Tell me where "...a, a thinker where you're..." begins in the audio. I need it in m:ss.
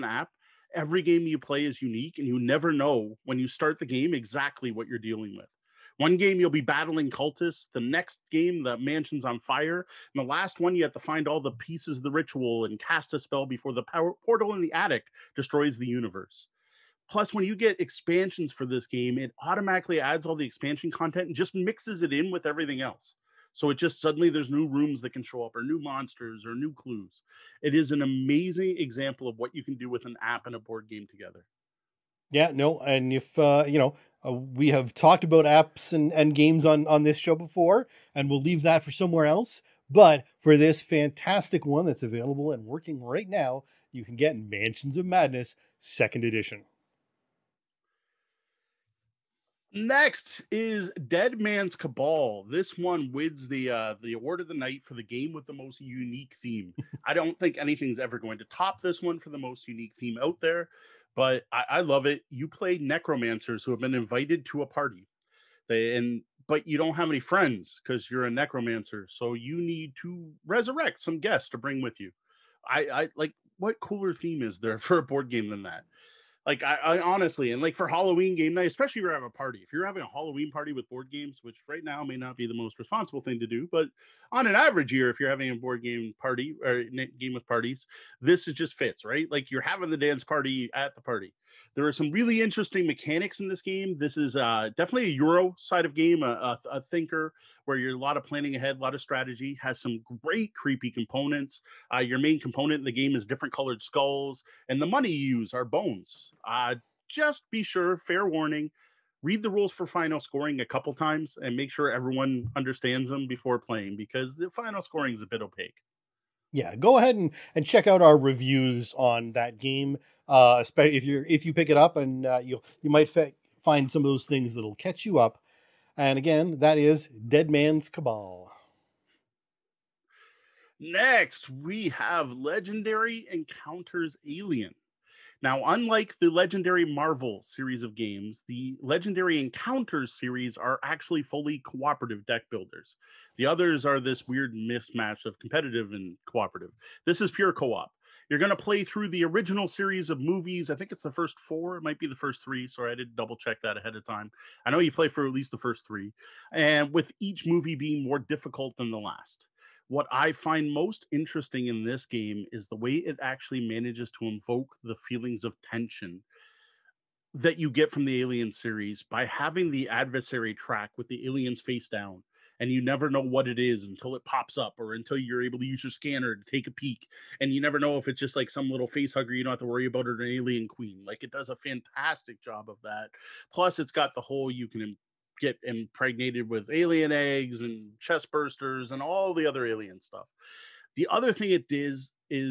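1:36.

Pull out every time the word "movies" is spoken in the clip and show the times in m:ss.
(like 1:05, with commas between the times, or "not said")
2:30, 2:37.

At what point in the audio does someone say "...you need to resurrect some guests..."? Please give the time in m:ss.
1:09.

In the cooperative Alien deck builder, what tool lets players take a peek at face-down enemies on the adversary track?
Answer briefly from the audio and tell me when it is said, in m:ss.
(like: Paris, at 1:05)
Scanner, at 2:55.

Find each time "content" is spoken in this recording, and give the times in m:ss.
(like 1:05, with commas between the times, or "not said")
0:20.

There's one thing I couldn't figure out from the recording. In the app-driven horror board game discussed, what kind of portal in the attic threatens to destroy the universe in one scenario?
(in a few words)
Power portal.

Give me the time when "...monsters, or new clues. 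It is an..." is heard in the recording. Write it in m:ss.
0:25.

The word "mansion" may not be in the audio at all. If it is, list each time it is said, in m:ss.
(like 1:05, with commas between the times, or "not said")
0:08, 0:44.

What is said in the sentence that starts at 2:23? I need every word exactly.
The others are this weird mismatch of competitive and cooperative.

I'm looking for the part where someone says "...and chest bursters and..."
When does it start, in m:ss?
3:07.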